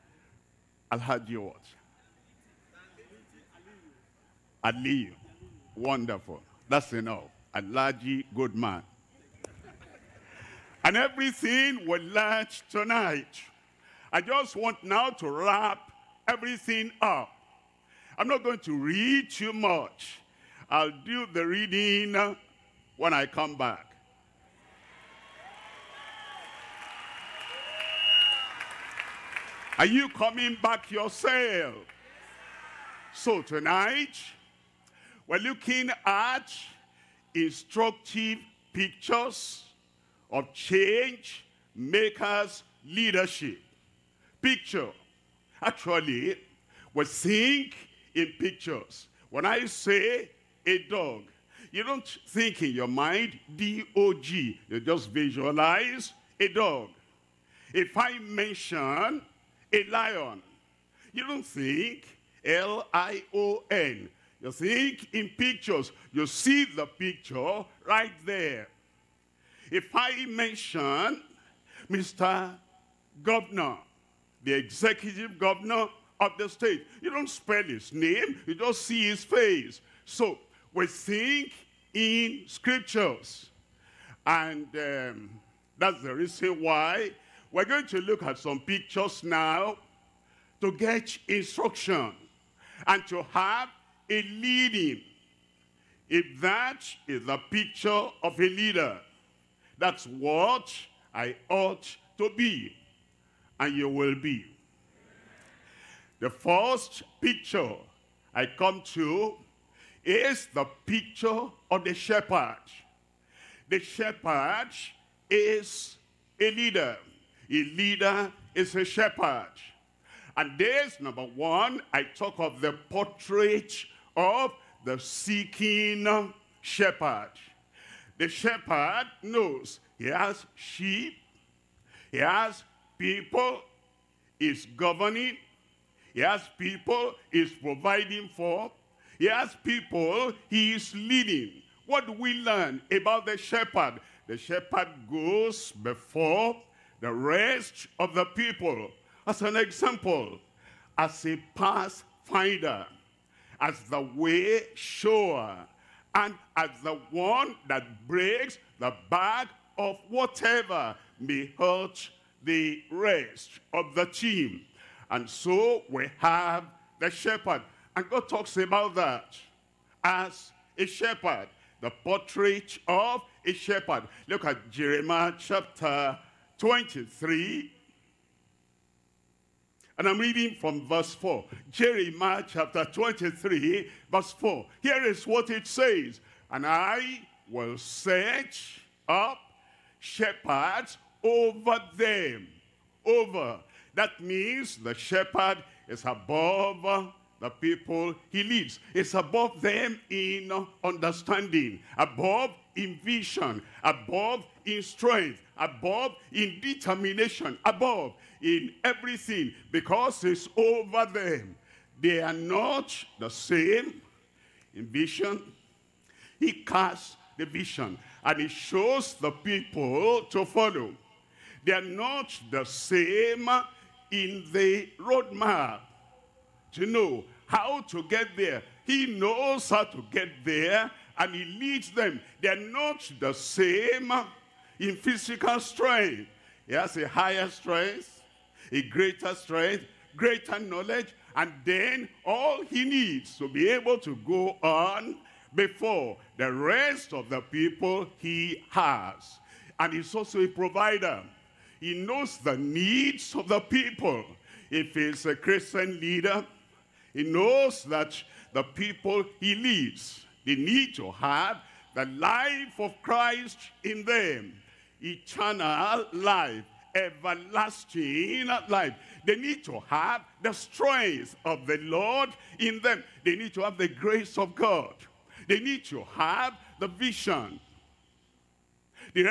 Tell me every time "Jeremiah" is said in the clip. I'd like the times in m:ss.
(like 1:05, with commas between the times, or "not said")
2:54, 3:01.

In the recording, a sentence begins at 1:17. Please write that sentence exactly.
You don't spell his name, you just see his face.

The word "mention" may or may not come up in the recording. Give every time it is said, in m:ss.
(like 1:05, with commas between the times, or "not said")
0:58, 1:10.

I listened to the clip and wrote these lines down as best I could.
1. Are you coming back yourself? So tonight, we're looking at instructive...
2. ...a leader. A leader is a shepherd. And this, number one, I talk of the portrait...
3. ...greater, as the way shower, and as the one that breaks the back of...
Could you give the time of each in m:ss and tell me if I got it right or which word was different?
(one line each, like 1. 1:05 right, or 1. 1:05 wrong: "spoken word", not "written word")
1. 0:29 right
2. 1:56 right
3. 2:31 wrong: "pathfinder", not "greater".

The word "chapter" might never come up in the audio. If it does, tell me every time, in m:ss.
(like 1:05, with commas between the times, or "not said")
2:55, 3:02.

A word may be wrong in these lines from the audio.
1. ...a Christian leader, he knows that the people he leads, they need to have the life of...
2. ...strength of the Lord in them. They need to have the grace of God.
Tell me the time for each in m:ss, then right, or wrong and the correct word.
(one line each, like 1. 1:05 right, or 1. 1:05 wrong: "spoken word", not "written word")
1. 4:15 right
2. 4:30 right.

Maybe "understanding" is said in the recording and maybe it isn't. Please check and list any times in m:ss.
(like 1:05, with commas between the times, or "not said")
3:20.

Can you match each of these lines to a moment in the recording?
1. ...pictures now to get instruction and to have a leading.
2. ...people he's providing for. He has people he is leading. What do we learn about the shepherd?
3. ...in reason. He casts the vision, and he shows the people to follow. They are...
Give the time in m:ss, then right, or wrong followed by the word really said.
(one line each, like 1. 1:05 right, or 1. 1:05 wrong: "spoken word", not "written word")
1. 1:28 right
2. 2:16 right
3. 3:34 wrong: "vision", not "reason".